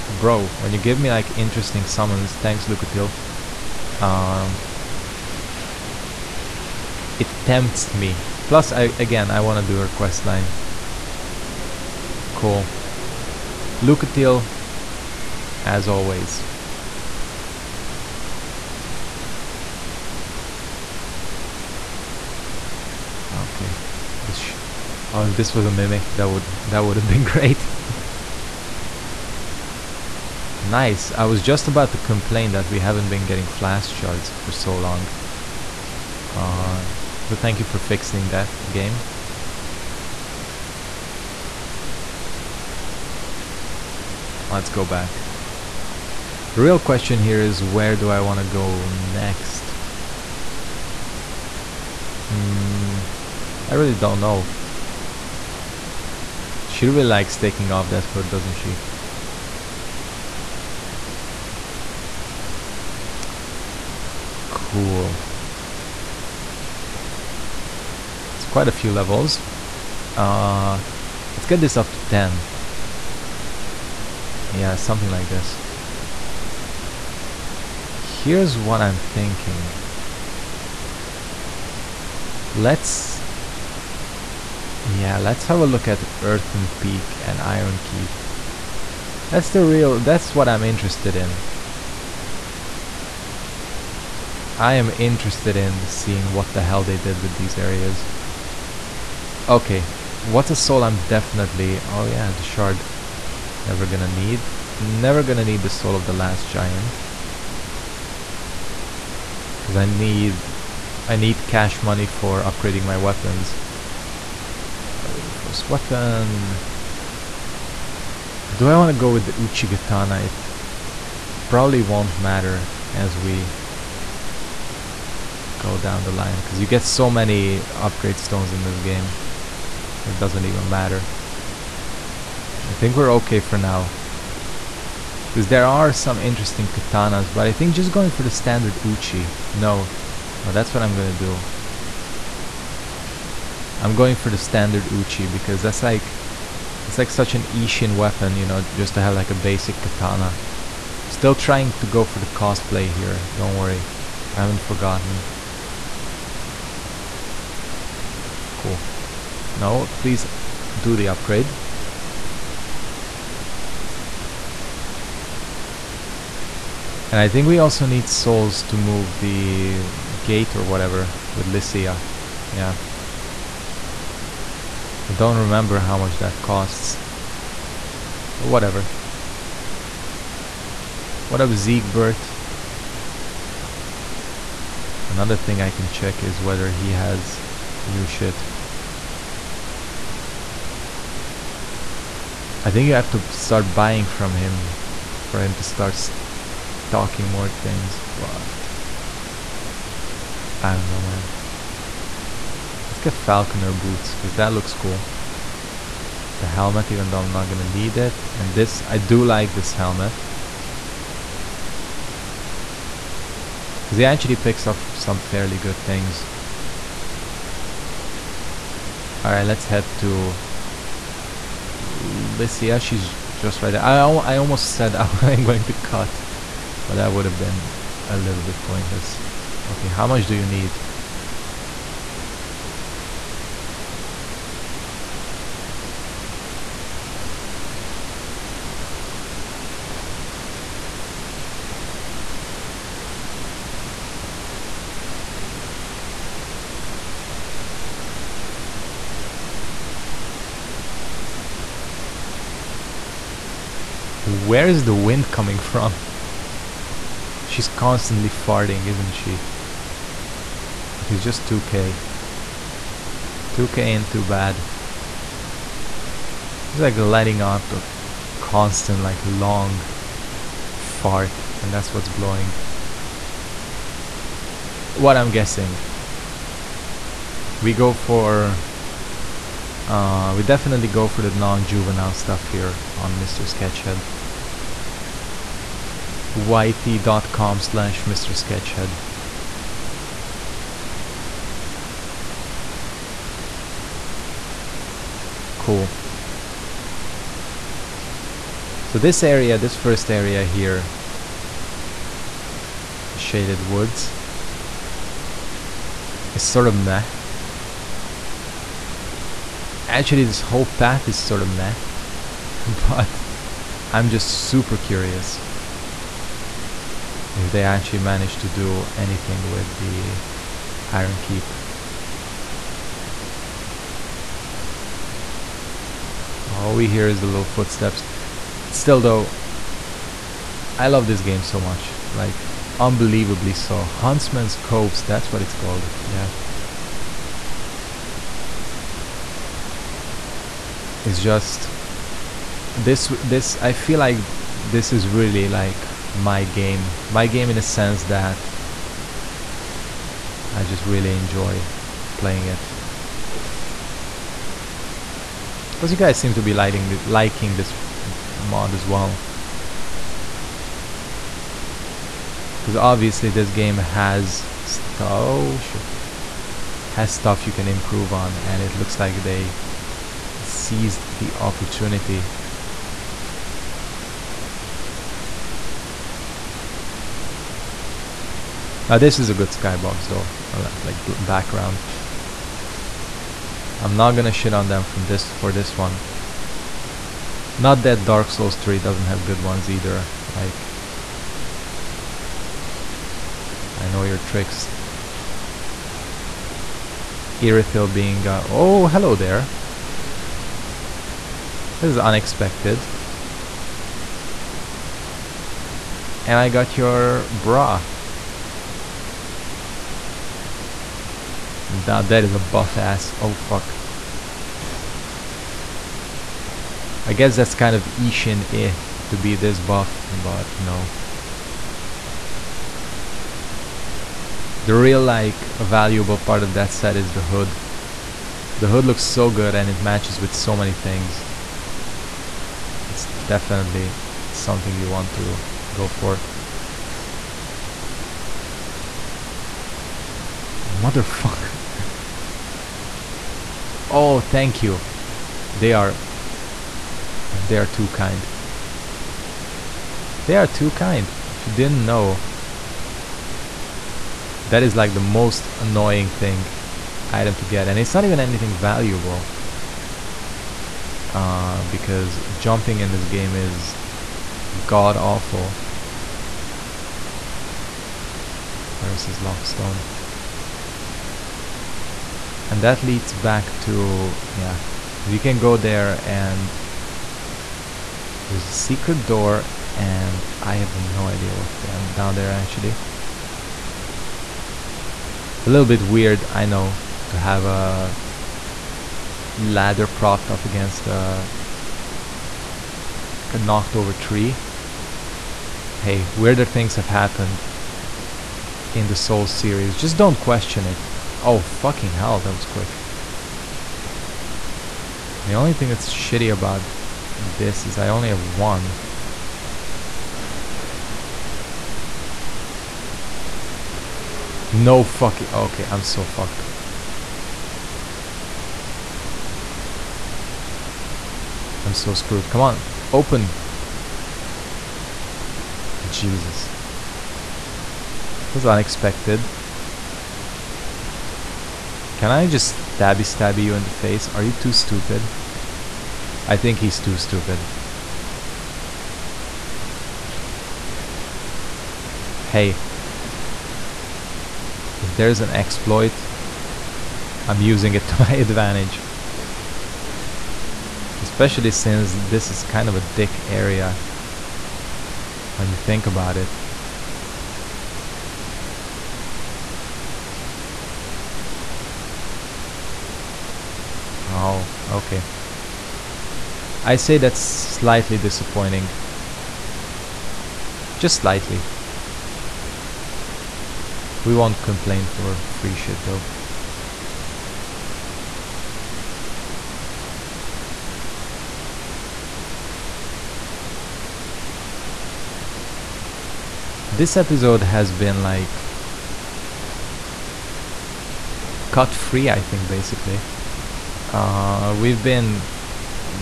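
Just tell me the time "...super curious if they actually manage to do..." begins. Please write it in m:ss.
5:14.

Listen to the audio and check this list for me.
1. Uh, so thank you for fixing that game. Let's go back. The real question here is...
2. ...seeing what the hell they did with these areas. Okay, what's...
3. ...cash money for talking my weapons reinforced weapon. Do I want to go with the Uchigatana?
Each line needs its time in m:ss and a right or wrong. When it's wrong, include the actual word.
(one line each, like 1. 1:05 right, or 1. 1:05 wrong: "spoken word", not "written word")
1. 0:36 right
2. 1:35 right
3. 1:51 wrong: "upgrading", not "talking".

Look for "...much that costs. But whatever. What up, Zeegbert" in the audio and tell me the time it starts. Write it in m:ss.
2:55.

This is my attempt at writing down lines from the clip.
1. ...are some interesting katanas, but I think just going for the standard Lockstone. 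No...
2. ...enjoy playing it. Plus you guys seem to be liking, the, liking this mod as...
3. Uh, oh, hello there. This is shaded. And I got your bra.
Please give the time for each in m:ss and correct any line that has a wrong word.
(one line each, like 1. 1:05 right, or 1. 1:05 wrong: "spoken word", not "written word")
1. 2:15 wrong: "Uchi", not "Lockstone"
2. 5:51 right
3. 6:38 wrong: "unexpected", not "shaded".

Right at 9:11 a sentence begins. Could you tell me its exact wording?
Especially since this is kind of a dick area.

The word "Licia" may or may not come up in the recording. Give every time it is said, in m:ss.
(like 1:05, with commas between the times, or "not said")
2:51, 3:41.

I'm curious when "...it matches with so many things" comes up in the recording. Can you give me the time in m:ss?
7:09.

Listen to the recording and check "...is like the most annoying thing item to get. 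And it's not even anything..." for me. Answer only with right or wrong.
right.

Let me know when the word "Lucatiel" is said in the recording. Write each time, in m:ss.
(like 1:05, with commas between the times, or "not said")
0:02, 0:13.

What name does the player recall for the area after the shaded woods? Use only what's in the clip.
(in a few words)
Huntsman's Copse.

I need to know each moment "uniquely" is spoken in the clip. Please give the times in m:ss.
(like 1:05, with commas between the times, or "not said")
not said.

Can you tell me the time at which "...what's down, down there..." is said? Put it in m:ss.
8:01.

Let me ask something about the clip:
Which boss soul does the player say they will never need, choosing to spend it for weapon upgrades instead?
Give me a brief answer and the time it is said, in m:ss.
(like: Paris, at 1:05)
Soul of the Last Giant, at 1:45.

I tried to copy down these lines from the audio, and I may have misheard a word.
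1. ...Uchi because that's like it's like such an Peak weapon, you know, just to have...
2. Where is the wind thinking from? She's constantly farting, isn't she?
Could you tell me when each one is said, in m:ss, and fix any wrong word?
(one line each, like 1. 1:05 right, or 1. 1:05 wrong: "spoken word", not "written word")
1. 2:24 wrong: "Isshin", not "Peak"
2. 4:14 wrong: "coming", not "thinking".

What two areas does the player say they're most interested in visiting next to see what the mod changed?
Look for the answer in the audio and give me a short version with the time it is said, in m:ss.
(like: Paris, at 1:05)
Earthen Peak and Iron Keep, at 1:26.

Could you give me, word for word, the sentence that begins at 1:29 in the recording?
That's the real, that's what I'm interested in.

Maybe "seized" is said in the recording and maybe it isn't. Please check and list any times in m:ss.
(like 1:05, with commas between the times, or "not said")
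6:10.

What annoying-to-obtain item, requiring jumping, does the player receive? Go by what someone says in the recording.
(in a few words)
Ferris' Lockstone.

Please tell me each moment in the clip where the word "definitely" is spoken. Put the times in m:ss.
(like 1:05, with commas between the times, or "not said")
1:41, 4:40, 7:13.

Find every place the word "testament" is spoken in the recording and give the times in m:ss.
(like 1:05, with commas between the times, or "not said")
not said.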